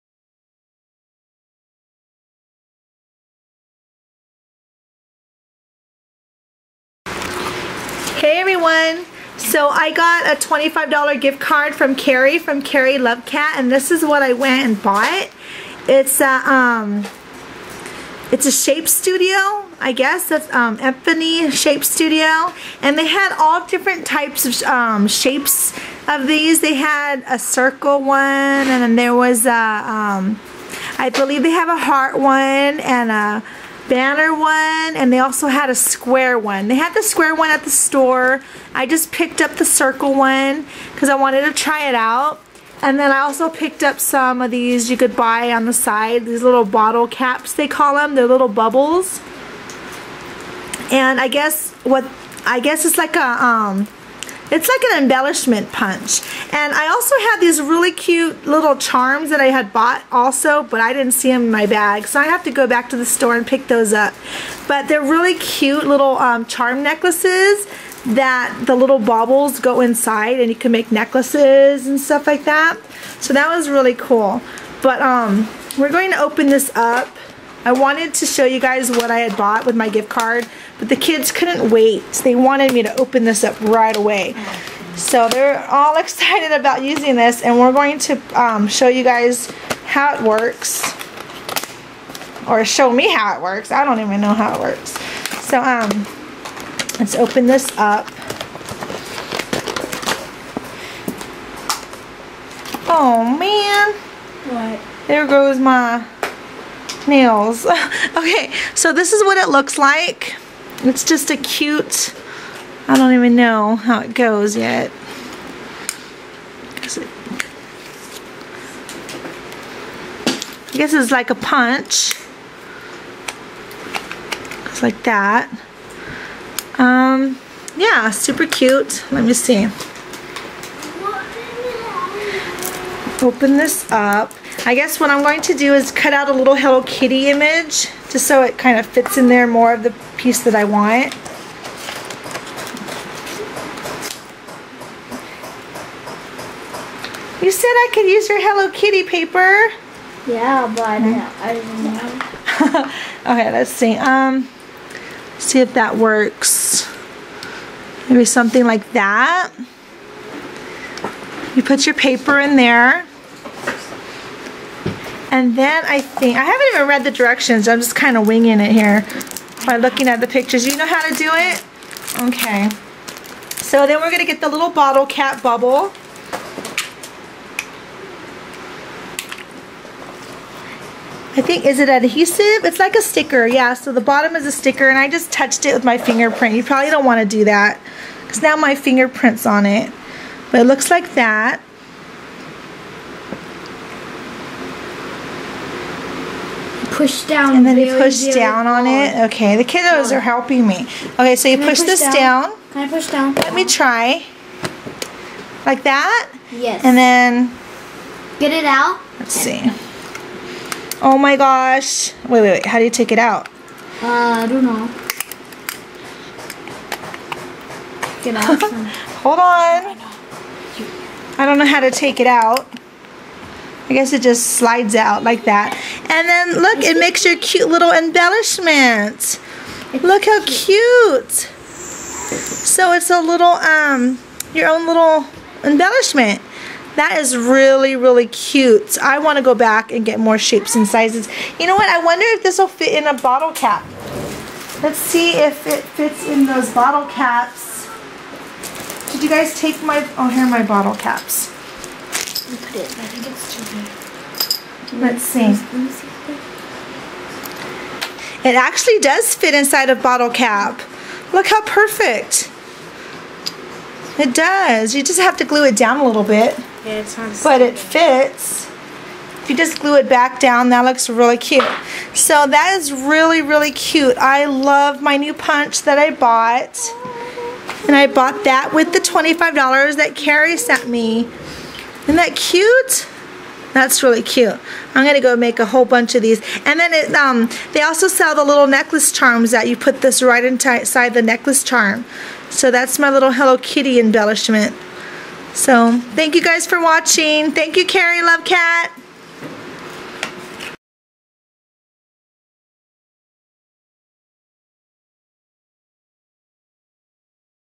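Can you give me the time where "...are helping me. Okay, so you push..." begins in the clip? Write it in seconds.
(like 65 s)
200 s.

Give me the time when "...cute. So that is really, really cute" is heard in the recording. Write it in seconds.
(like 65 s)
271 s.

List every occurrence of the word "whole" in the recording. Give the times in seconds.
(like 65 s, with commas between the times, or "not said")
285 s.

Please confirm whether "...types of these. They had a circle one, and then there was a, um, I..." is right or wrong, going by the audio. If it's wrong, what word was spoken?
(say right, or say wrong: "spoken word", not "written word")
wrong: "shapes", not "types".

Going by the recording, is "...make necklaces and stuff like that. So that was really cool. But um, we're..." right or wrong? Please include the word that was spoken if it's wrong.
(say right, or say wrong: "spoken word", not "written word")
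right.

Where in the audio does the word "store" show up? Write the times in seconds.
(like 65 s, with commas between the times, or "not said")
37 s, 63 s.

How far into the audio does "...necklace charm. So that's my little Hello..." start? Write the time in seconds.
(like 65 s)
291 s.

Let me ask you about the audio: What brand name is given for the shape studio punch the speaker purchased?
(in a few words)
Epiphany.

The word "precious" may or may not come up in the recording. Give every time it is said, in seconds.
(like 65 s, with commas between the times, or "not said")
not said.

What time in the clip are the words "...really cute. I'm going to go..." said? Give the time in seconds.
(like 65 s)
284 s.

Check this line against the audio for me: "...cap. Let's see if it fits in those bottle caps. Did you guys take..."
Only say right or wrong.
right.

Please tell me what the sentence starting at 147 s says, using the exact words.
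You said I could use your Hello Kitty paper.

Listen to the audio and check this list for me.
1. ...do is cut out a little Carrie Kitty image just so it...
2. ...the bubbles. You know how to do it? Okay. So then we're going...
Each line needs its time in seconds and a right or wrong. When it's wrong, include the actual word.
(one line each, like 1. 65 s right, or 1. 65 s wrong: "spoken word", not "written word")
1. 135 s wrong: "Hello", not "Carrie"
2. 170 s wrong: "pictures", not "bubbles".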